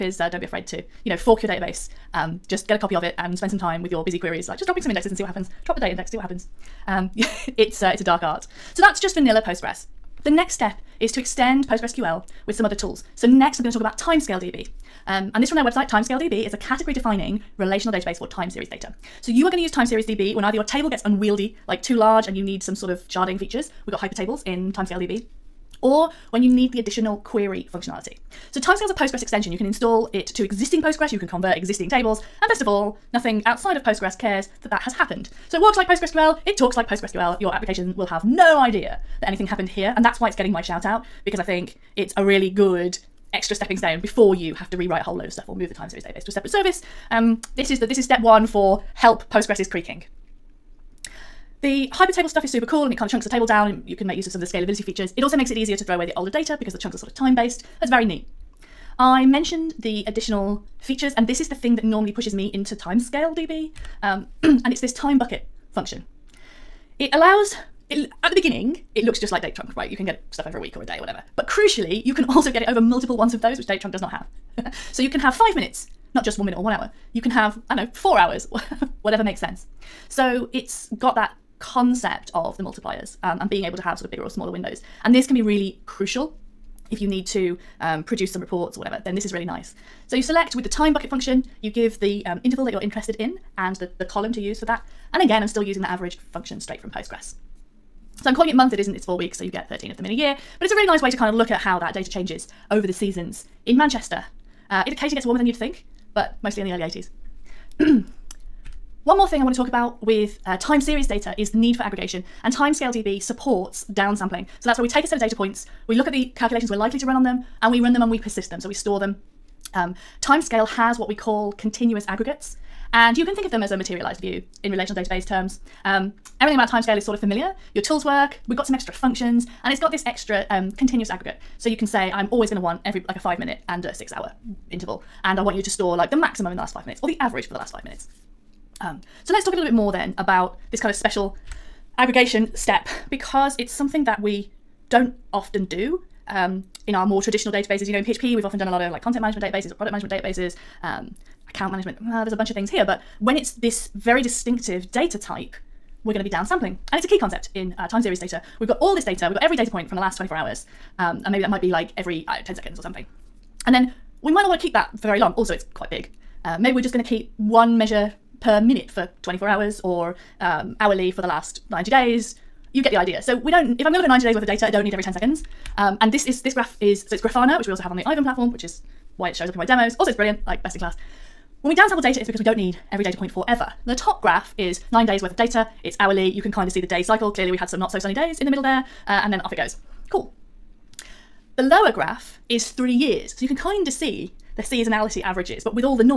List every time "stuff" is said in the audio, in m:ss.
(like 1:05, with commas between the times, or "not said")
0:45, 0:52, 1:10.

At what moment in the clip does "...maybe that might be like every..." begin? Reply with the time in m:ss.
2:41.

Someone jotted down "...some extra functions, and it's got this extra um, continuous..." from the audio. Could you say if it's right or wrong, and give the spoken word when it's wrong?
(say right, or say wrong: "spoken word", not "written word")
right.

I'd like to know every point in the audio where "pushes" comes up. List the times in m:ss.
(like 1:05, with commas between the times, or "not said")
1:02.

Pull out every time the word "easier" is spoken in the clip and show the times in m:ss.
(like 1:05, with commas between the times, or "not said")
0:55.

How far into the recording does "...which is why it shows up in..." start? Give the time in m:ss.
2:58.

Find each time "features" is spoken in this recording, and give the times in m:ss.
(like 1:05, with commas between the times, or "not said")
0:23, 0:54, 1:00.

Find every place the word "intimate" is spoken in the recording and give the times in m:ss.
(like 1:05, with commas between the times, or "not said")
not said.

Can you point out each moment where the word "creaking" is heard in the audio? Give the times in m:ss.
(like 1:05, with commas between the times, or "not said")
0:49.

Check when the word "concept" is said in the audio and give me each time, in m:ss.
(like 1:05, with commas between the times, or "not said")
1:21, 2:37.